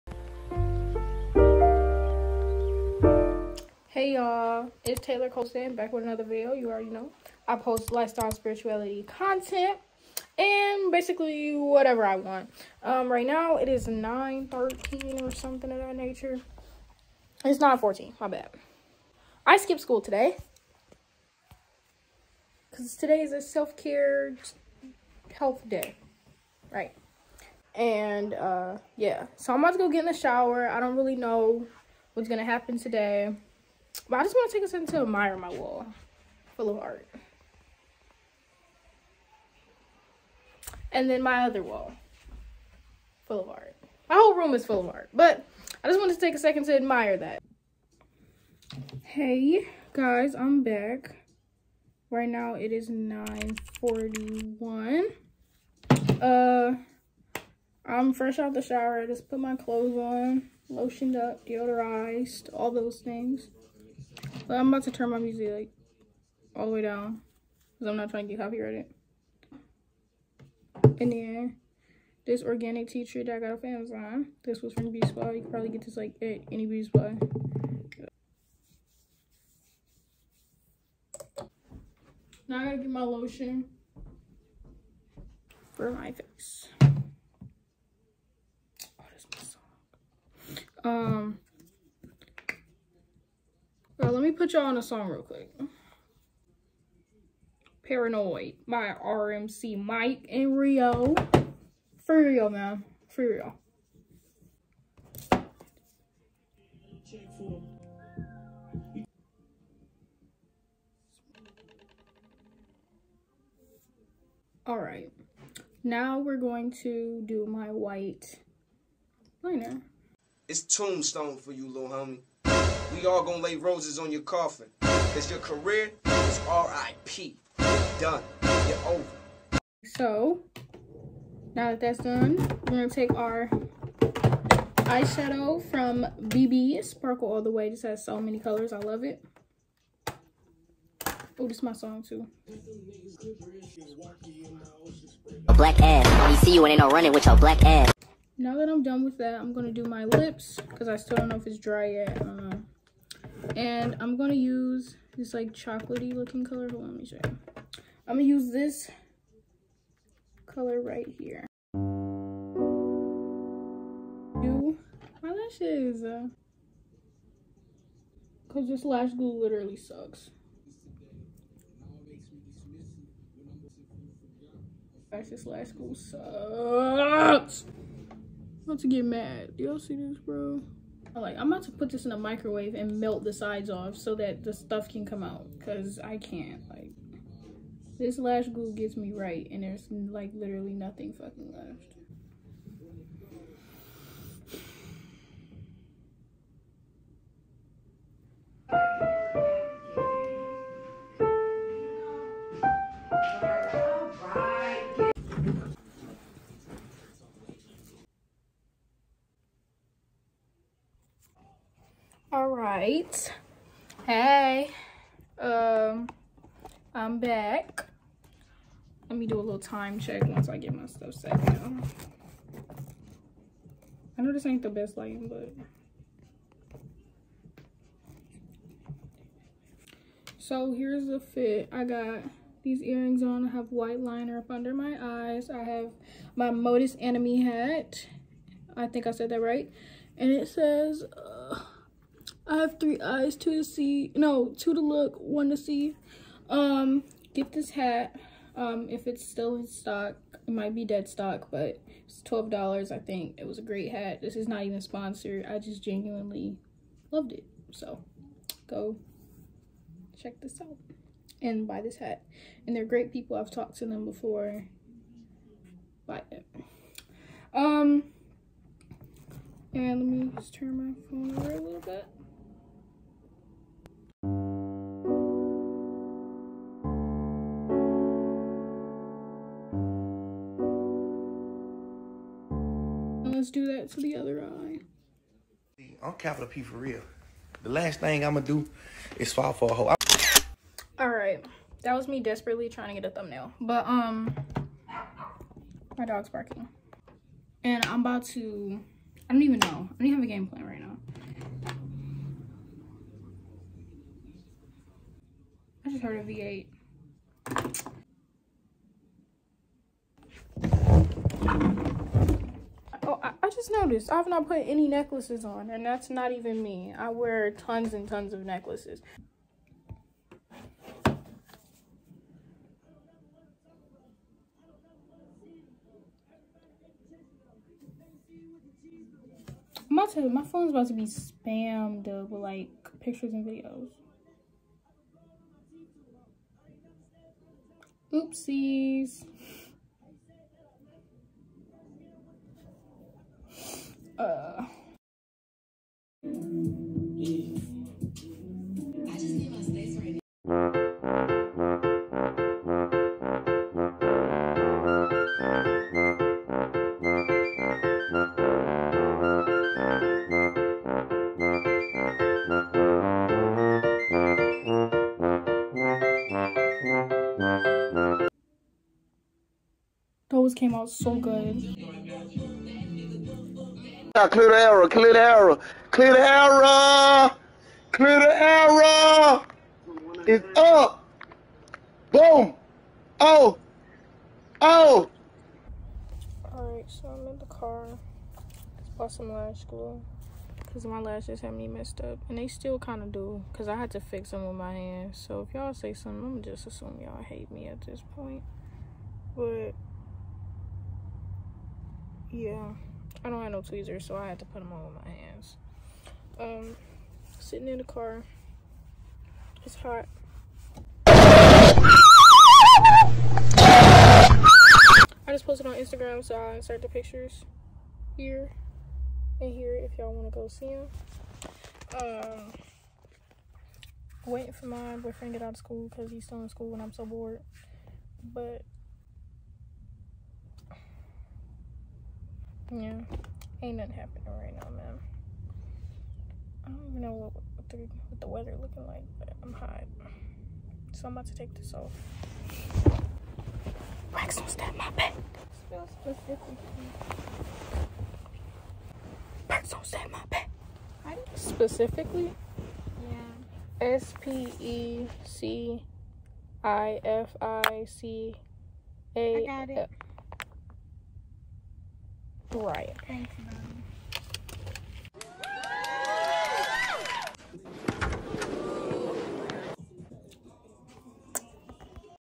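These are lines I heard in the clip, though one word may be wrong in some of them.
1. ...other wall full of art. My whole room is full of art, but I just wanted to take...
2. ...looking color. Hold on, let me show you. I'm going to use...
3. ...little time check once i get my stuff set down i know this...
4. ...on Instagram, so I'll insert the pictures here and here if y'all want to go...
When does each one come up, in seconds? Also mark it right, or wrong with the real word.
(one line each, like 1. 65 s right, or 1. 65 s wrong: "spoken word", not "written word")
1. 41 s right
2. 156 s right
3. 219 s right
4. 415 s right.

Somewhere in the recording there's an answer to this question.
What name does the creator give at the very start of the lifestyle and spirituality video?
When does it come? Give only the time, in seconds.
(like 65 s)
5 s.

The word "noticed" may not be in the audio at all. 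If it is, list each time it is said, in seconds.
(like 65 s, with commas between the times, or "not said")
313 s.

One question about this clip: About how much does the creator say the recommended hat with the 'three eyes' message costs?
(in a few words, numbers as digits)
$12.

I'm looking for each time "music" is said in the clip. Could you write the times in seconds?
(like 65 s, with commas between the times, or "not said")
65 s.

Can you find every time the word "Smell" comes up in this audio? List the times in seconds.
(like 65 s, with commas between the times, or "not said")
445 s.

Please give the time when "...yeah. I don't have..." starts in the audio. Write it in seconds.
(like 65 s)
402 s.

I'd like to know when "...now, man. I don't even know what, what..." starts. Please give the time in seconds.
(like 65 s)
434 s.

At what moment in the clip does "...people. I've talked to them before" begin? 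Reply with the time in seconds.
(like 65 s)
263 s.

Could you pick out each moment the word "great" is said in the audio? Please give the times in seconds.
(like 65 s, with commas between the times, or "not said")
253 s, 262 s.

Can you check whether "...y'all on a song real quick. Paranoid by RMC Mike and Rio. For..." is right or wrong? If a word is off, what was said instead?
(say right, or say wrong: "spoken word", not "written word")
right.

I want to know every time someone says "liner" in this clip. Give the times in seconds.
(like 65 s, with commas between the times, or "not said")
119 s, 233 s.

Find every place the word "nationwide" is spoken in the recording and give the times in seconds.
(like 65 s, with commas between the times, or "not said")
not said.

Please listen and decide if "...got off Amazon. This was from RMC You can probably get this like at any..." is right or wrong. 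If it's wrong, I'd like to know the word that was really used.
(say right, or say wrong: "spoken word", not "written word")
wrong: "Beauty", not "RMC".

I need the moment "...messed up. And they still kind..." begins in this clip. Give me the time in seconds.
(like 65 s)
391 s.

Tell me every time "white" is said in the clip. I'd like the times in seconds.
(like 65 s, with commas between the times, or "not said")
117 s, 233 s.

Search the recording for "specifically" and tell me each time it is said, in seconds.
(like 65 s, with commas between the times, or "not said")
446 s, 451 s.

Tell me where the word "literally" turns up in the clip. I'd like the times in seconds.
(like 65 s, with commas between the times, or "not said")
169 s, 190 s.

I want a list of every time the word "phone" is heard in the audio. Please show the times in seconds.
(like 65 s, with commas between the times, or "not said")
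271 s, 330 s.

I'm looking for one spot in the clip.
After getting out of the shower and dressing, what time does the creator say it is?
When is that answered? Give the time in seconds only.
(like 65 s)
52 s.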